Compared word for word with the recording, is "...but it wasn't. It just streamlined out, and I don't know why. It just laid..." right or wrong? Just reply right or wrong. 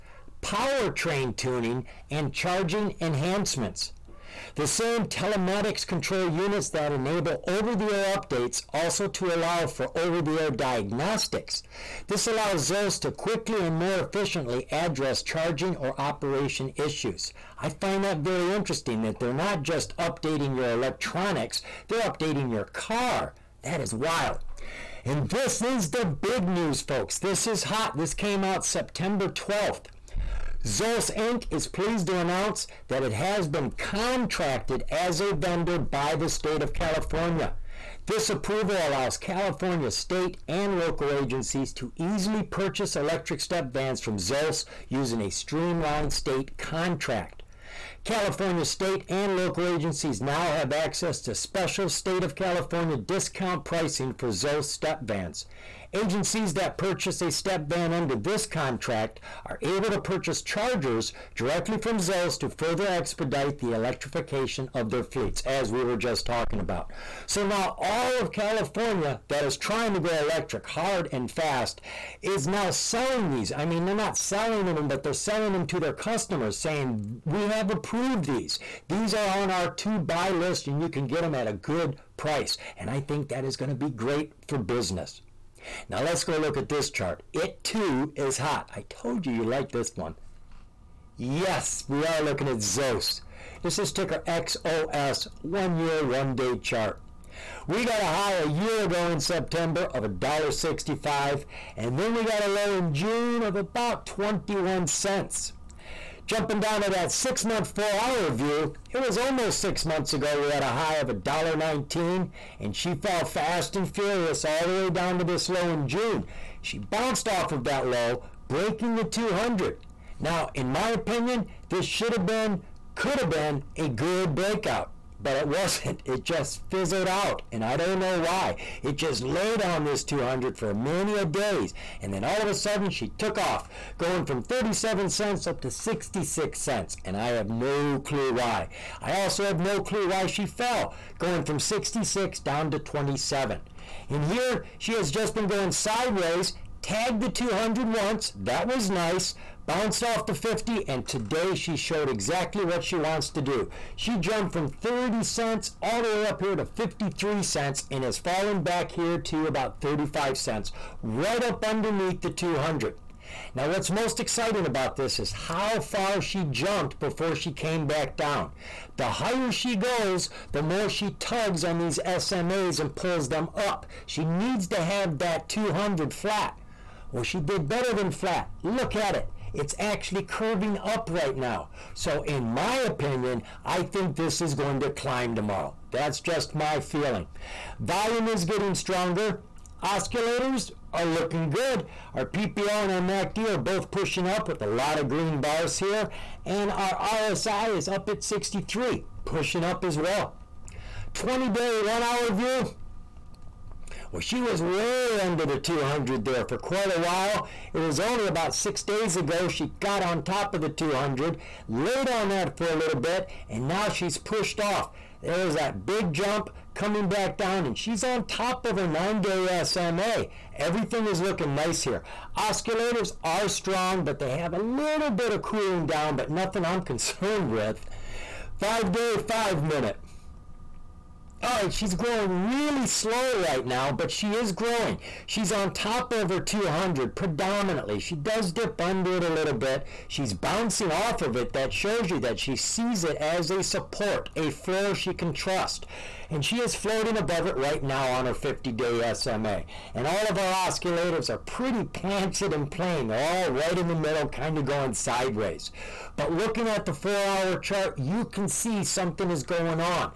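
wrong.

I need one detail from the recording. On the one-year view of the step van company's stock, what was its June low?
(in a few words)
about 21 cents.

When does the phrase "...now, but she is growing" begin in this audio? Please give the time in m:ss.
3:53.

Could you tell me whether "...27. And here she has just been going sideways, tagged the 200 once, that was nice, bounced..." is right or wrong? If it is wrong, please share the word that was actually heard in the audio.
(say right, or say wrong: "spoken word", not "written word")
right.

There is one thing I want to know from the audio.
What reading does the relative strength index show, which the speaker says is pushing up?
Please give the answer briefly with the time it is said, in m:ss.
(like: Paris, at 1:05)
63, at 3:18.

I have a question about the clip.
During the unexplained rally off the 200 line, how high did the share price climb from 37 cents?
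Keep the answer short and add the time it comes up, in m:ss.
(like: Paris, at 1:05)
66 cents, at 2:15.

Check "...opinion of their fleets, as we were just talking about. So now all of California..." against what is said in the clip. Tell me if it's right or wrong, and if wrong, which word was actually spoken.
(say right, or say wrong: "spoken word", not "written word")
wrong: "electrification", not "opinion".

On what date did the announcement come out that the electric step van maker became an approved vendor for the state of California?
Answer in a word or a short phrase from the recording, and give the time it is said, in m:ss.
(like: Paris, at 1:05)
September 12th, at 0:28.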